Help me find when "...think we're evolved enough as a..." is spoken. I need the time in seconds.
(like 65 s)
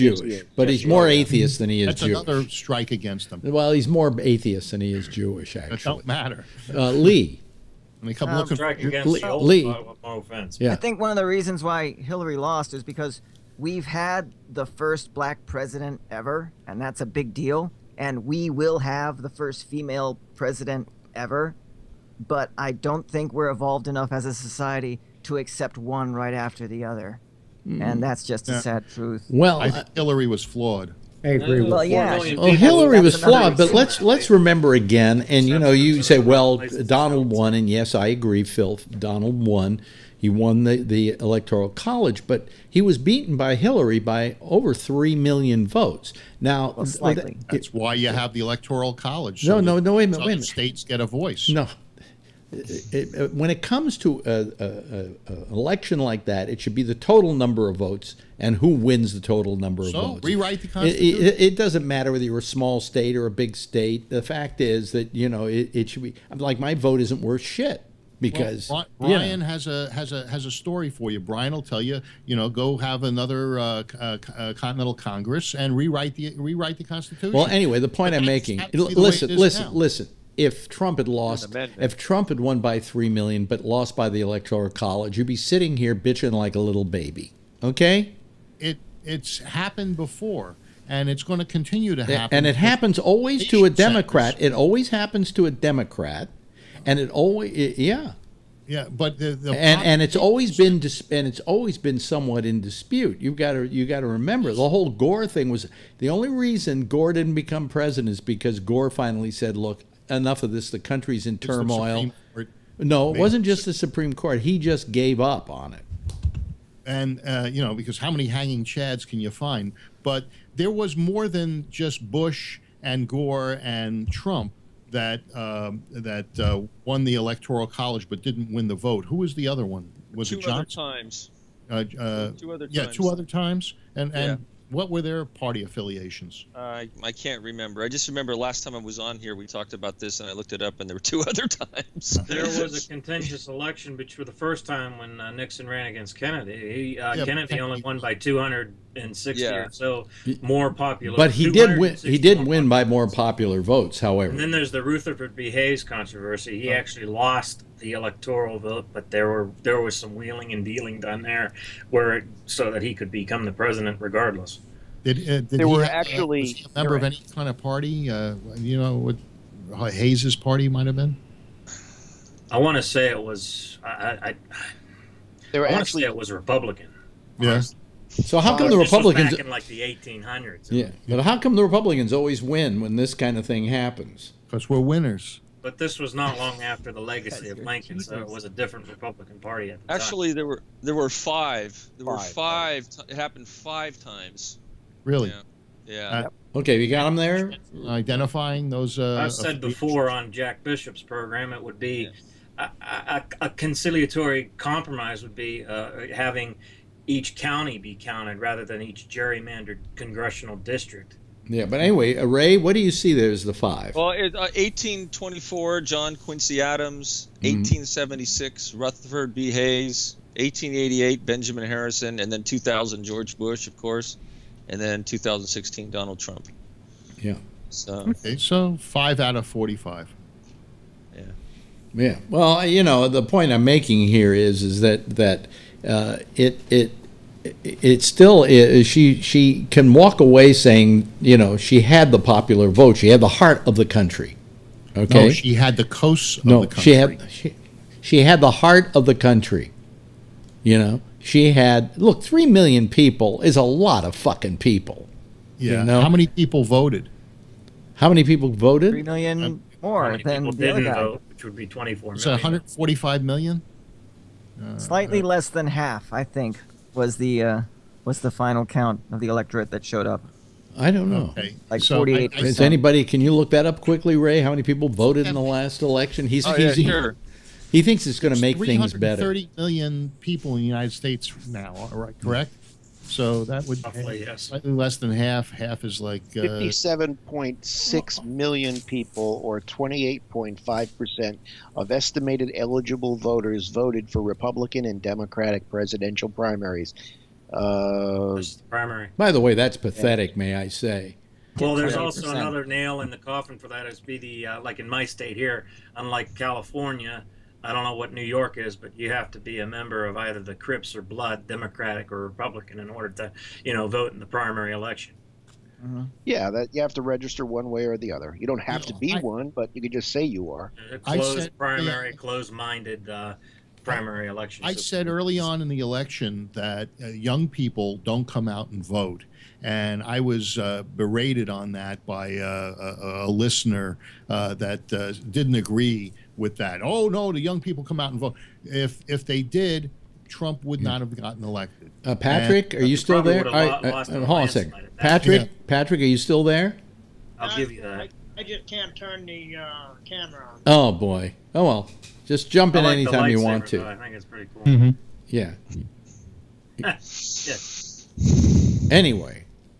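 23 s.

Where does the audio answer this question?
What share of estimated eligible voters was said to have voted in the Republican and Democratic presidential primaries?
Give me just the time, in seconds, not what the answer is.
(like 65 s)
289 s.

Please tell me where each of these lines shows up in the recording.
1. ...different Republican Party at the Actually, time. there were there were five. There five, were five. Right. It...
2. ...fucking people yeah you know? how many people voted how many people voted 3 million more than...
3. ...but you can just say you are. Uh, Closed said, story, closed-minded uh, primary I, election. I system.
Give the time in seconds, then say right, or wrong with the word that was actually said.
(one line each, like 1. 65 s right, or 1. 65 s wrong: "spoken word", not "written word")
1. 188 s right
2. 254 s right
3. 319 s wrong: "primary", not "story".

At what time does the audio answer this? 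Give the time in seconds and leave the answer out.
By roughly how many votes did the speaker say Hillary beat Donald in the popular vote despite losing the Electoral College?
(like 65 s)
44 s.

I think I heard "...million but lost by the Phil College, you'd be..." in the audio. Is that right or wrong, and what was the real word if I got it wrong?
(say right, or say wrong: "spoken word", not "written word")
wrong: "Electoral", not "Phil".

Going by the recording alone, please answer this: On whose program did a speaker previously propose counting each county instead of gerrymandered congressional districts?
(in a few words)
Jack Bishop.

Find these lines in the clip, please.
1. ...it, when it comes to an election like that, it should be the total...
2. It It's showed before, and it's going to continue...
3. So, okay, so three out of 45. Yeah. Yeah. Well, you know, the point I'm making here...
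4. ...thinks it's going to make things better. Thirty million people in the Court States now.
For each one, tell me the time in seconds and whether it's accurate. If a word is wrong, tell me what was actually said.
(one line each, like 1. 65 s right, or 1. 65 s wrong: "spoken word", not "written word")
1. 53 s right
2. 88 s wrong: "happened", not "showed"
3. 227 s wrong: "five", not "three"
4. 277 s wrong: "United", not "Court".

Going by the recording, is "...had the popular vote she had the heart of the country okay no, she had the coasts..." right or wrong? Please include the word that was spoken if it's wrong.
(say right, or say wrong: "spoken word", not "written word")
right.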